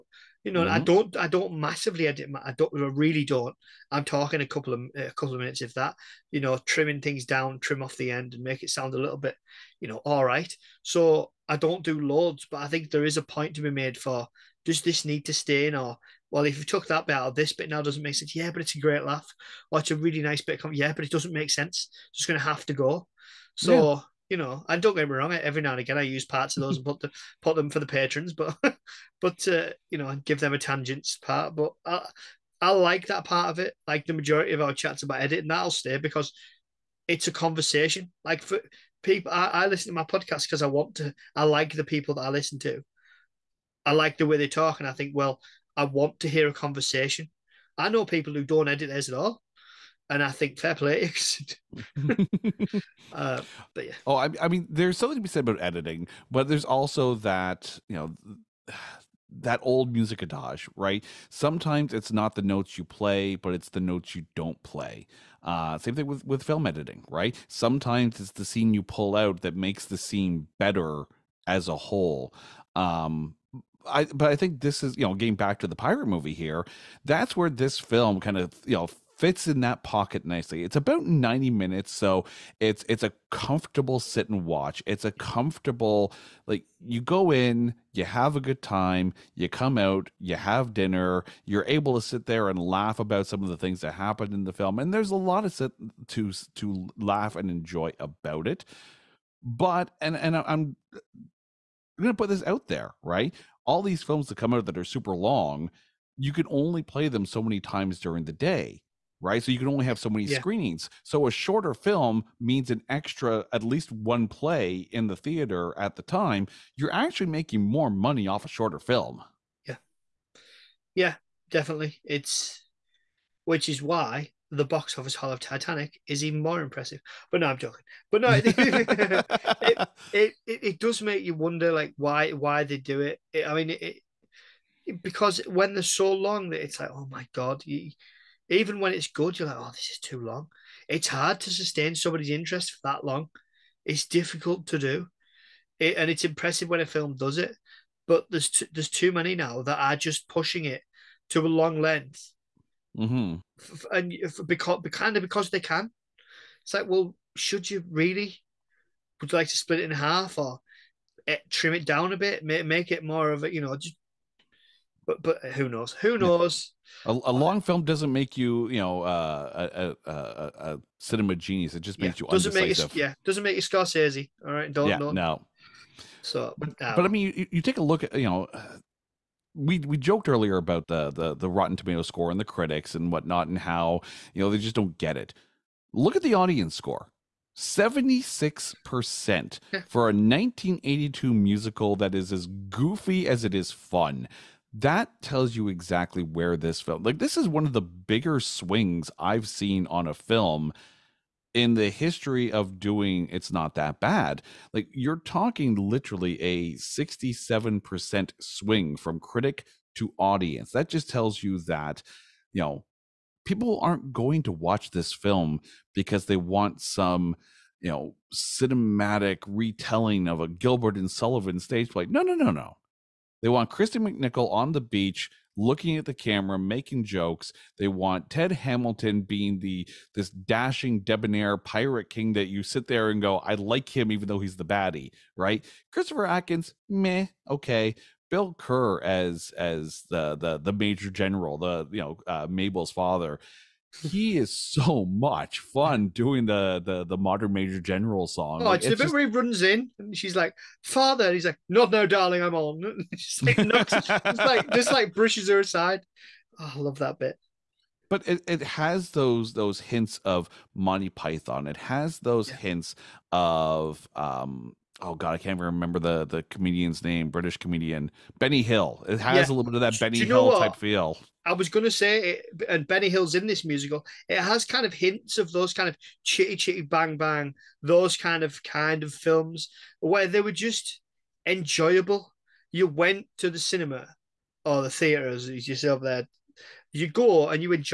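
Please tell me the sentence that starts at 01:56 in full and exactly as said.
You're actually making more money off a shorter film.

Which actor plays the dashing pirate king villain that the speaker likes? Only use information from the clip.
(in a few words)
Ted Hamilton.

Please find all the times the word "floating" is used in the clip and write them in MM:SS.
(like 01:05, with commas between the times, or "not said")
not said.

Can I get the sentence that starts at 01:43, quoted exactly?
All these films that come out that are super long, you can only play them so many times during the day right?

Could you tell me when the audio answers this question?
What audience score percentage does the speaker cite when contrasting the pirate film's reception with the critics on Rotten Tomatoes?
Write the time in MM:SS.
03:07.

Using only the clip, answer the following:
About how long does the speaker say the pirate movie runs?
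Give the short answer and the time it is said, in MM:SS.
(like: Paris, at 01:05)
90 minutes, at 01:21.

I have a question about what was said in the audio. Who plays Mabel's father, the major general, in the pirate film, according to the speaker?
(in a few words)
Bill Kerr.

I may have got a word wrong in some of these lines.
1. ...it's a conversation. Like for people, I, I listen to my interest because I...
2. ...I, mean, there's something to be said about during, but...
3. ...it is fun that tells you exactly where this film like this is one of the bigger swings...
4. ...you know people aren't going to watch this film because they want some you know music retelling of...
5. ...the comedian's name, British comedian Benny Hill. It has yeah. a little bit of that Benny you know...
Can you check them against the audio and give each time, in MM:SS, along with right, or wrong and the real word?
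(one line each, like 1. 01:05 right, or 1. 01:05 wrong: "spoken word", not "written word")
1. 00:37 wrong: "podcast", not "interest"
2. 00:54 wrong: "editing", not "during"
3. 03:13 right
4. 03:32 wrong: "cinematic", not "music"
5. 04:26 right.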